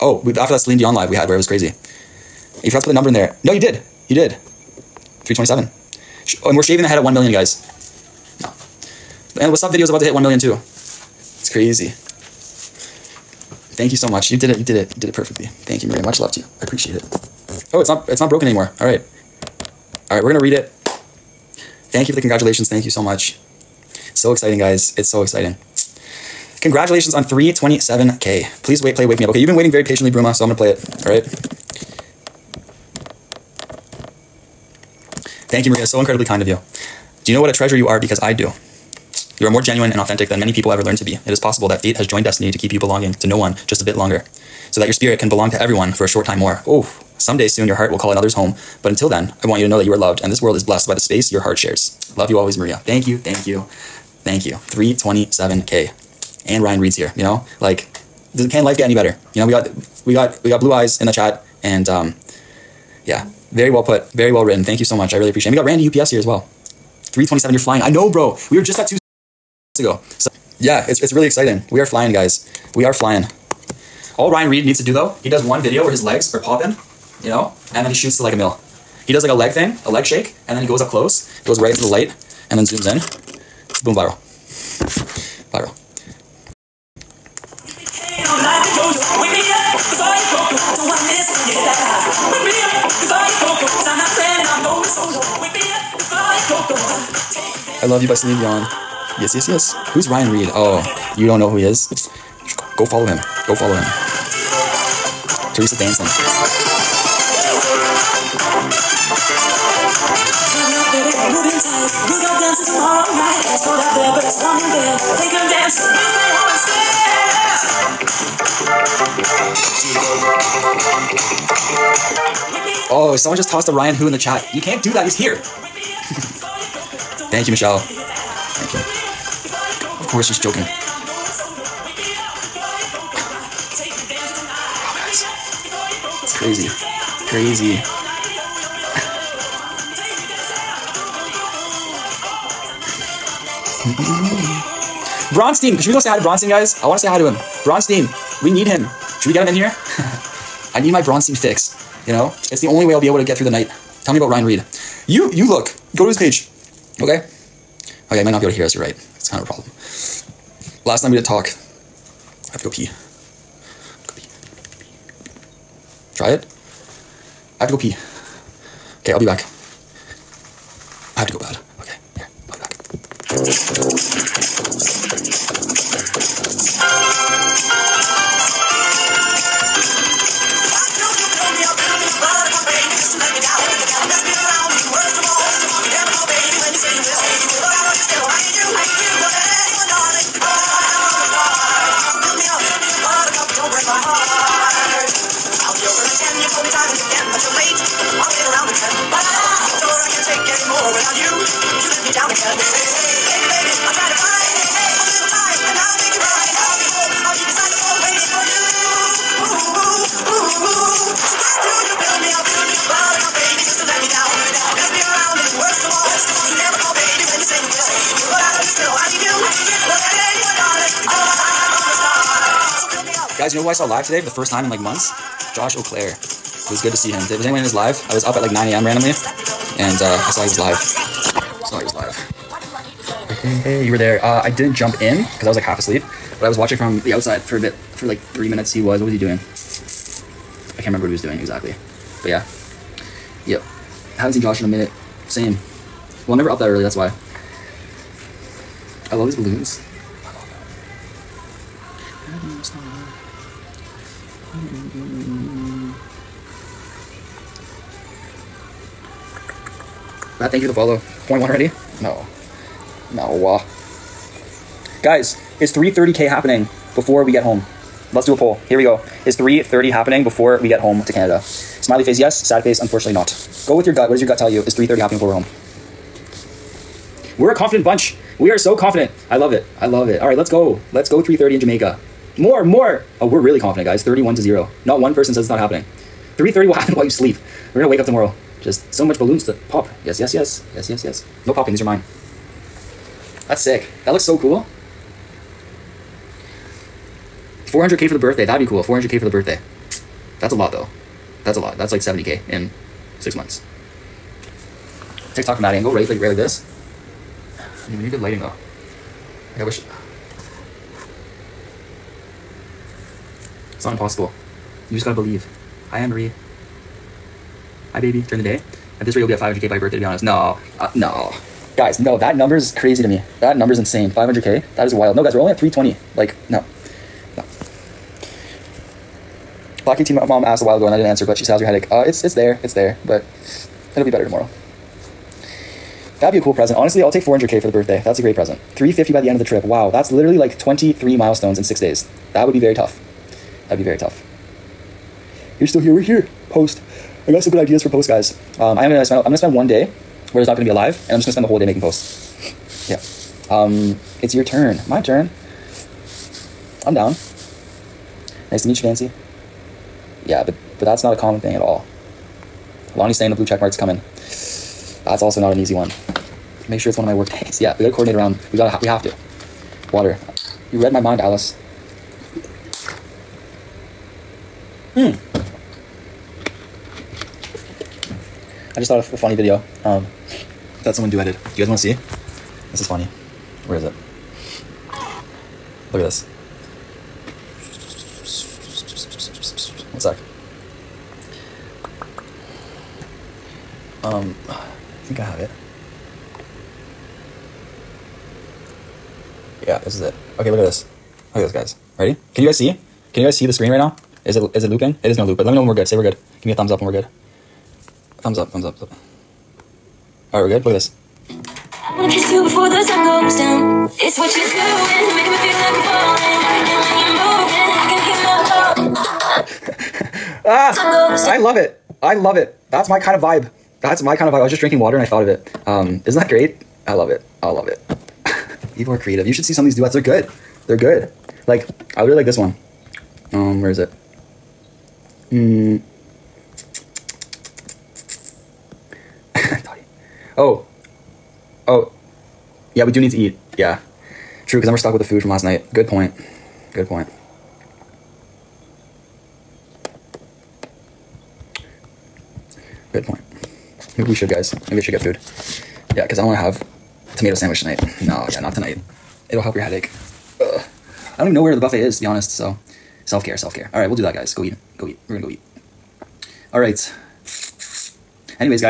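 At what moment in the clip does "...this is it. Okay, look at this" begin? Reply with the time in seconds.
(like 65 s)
399 s.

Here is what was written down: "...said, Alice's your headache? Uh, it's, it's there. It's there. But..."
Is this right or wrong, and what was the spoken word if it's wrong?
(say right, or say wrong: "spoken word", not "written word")
wrong: "How", not "Alice".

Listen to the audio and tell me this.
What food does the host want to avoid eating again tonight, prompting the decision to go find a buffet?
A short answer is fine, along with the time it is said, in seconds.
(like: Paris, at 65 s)
tomato sandwich, at 457 s.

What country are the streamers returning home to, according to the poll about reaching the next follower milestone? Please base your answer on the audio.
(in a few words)
Canada.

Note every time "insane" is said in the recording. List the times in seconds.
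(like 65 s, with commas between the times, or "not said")
323 s.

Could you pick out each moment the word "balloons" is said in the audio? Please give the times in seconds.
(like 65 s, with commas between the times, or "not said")
249 s, 289 s.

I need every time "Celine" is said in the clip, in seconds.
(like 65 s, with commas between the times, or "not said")
0 s, 98 s.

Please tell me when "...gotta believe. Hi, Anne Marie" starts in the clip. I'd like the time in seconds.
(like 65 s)
315 s.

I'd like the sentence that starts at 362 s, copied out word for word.
Lonnie's saying the blue check mark's coming.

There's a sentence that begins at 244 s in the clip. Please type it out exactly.
Haven't seen Josh in a minute.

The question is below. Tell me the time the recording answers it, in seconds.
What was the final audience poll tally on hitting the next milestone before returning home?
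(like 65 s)
284 s.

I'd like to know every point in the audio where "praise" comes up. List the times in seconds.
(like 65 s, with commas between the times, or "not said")
not said.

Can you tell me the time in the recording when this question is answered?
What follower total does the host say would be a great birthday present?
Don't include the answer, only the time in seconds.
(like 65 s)
337 s.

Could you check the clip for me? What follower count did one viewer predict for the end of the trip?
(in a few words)
350.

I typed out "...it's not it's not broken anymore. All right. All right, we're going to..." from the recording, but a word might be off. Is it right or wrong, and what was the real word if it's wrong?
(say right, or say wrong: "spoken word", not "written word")
right.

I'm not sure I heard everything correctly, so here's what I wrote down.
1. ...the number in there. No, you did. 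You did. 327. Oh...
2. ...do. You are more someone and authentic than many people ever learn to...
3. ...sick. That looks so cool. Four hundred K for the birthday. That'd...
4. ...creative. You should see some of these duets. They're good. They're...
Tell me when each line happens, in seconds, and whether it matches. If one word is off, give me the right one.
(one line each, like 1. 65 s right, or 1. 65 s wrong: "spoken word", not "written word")
1. 2 s right
2. 38 s wrong: "genuine", not "someone"
3. 293 s right
4. 428 s right.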